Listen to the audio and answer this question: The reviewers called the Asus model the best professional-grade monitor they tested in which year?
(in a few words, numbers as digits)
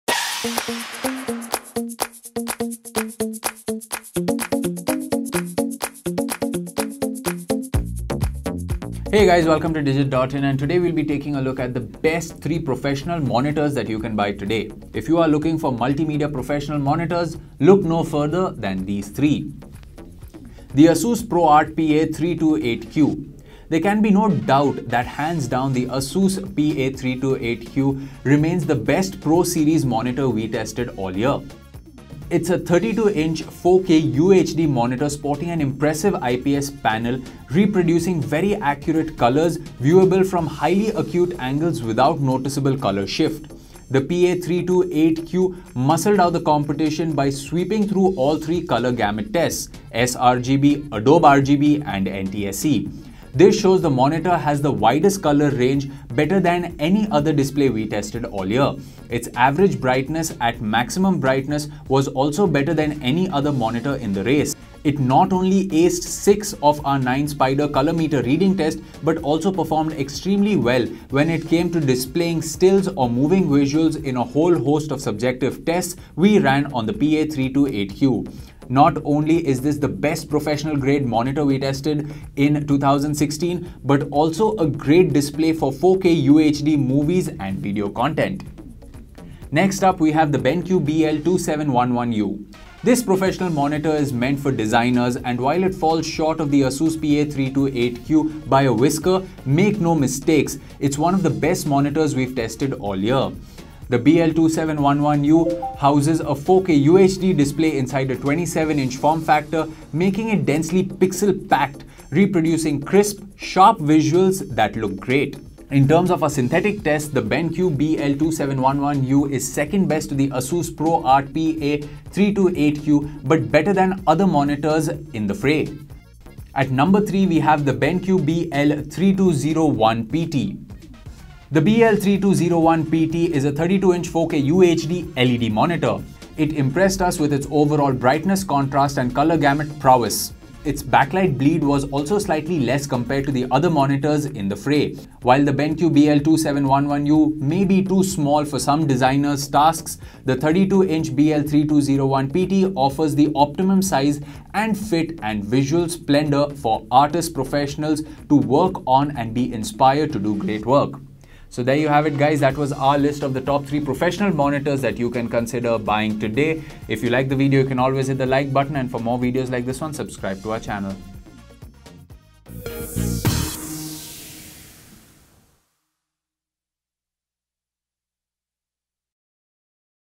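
2016.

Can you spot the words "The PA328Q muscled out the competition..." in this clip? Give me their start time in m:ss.
0:43.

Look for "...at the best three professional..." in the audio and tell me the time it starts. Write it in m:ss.
0:11.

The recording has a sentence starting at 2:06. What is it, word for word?
At number 3, we have the BenQ BL3201PT.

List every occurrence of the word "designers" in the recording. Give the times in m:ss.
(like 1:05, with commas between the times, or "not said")
1:34, 2:28.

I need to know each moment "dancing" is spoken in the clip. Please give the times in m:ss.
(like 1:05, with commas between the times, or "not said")
not said.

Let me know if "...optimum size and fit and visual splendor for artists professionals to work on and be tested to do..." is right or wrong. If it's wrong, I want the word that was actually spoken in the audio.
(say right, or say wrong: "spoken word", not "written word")
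wrong: "inspired", not "tested".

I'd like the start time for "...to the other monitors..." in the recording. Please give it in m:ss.
2:23.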